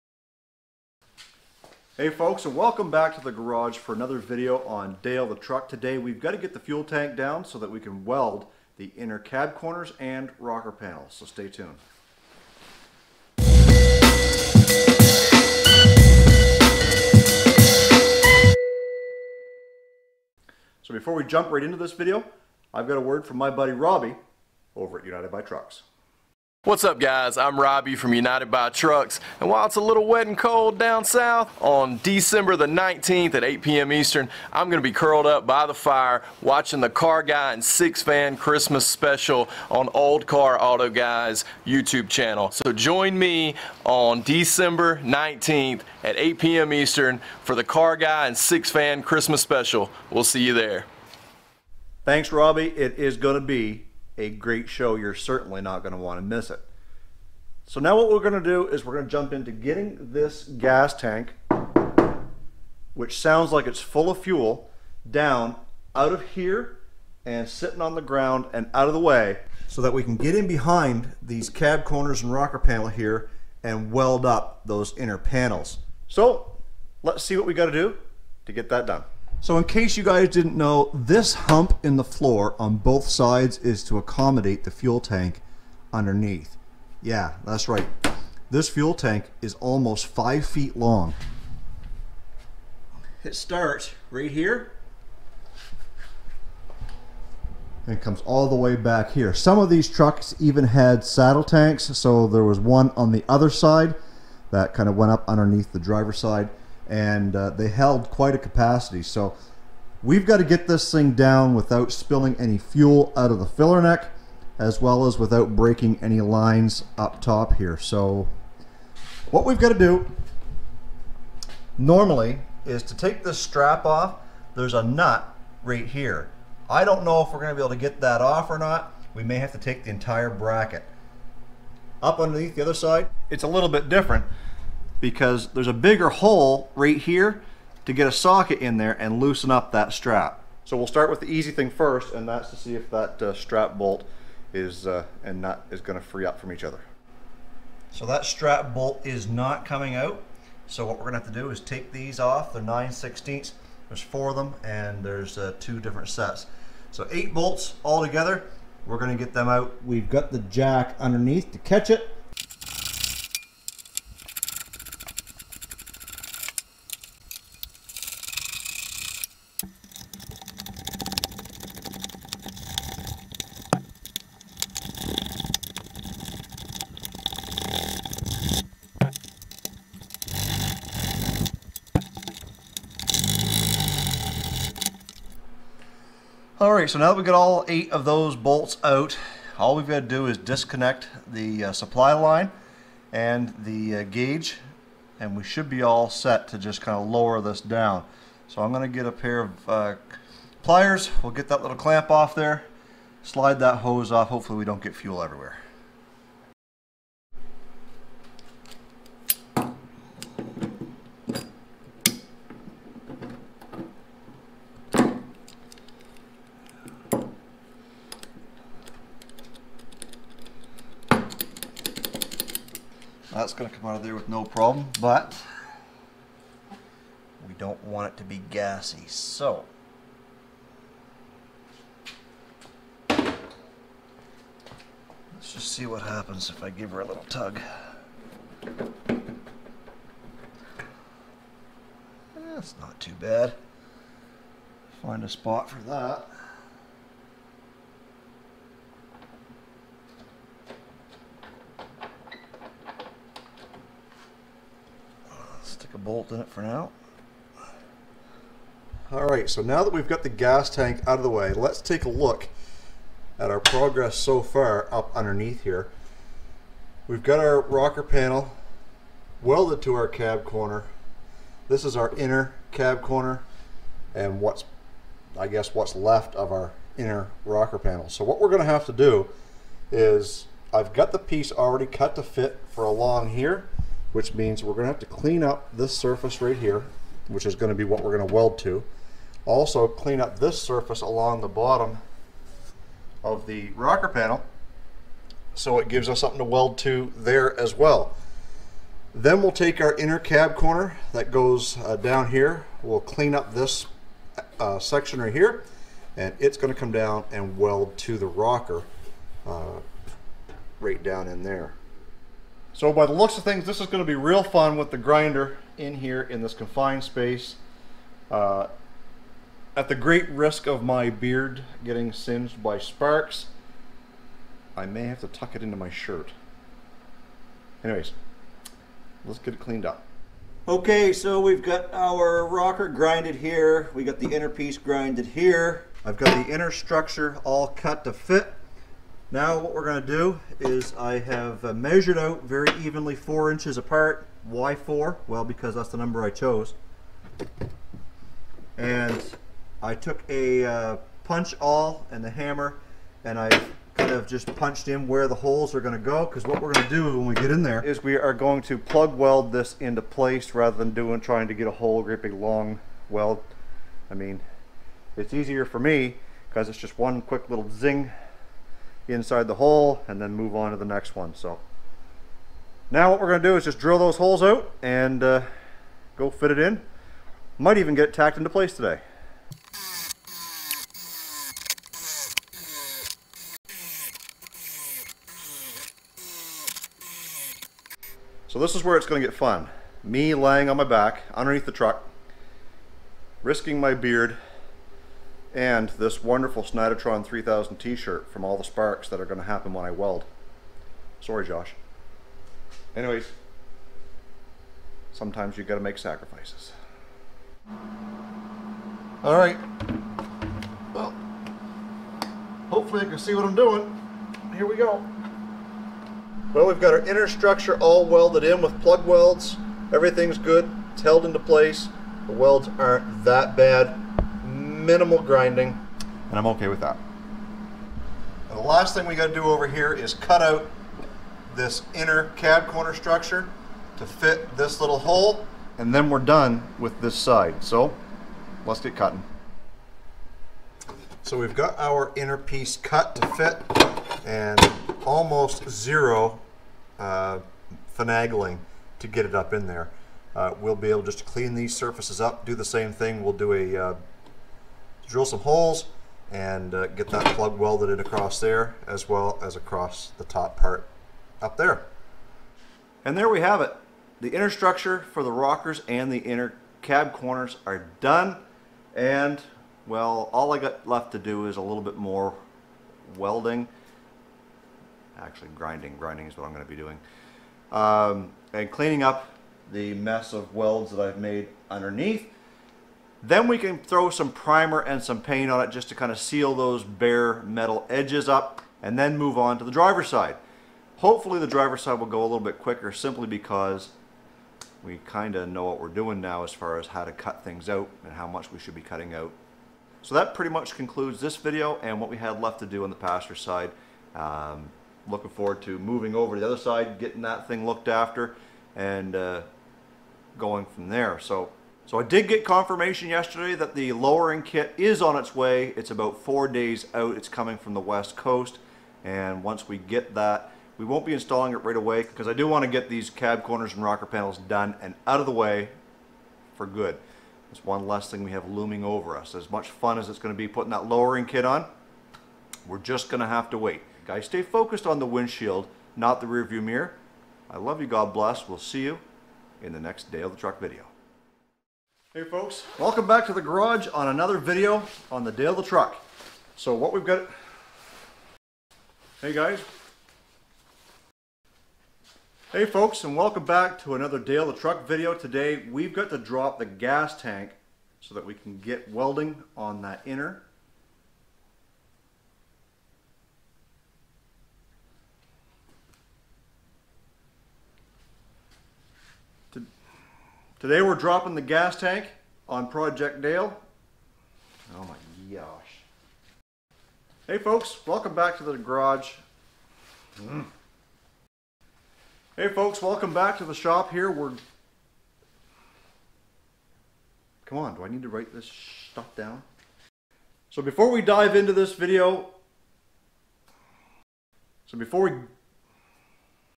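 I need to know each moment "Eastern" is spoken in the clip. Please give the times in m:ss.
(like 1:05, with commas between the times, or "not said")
0:33, 0:46.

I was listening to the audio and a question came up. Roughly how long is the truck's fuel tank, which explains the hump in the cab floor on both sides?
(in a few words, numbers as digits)
almost 5 feet.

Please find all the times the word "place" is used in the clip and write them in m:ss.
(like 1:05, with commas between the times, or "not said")
6:00, 6:18, 7:01.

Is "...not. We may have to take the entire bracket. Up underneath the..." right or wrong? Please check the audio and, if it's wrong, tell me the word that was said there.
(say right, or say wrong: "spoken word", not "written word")
right.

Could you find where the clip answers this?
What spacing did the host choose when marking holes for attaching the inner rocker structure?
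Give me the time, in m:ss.
5:43.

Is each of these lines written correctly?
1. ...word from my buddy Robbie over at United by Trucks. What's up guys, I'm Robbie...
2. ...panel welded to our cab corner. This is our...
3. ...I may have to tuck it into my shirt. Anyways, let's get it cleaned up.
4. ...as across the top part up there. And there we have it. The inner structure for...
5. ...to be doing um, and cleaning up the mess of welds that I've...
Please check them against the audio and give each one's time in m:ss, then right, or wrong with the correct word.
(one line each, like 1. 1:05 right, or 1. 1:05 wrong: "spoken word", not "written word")
1. 0:23 right
2. 4:28 right
3. 5:24 right
4. 7:39 right
5. 7:56 right.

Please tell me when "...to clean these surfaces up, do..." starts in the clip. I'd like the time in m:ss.
7:31.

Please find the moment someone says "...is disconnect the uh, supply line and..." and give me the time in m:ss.
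3:10.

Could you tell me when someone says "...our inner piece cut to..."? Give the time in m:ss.
7:21.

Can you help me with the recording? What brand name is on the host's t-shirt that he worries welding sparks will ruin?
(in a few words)
Snidotron 3000.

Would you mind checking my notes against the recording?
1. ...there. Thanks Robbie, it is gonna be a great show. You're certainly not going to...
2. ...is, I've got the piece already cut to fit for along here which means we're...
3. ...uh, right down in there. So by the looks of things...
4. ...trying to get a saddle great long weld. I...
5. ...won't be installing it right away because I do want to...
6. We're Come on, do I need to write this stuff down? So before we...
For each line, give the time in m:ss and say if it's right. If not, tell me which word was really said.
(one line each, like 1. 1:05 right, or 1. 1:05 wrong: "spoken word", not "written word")
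1. 0:50 right
2. 4:39 right
3. 5:09 right
4. 6:01 wrong: "whole", not "saddle"
5. 8:40 right
6. 9:44 right.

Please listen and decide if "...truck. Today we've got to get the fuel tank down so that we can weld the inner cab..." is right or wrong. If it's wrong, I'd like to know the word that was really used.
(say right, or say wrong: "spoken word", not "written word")
right.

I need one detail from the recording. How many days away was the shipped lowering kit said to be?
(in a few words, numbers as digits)
4 days.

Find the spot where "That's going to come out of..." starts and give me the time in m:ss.
3:43.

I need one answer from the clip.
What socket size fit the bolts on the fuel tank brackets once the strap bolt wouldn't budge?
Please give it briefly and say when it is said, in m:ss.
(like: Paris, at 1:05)
9/16, at 2:32.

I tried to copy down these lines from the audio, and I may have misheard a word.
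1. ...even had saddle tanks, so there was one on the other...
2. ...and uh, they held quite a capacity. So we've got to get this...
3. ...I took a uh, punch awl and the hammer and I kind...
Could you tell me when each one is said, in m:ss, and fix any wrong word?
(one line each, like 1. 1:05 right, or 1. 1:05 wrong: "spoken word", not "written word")
1. 1:40 right
2. 1:46 right
3. 5:49 right.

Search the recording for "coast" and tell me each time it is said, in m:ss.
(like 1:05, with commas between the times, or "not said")
8:38.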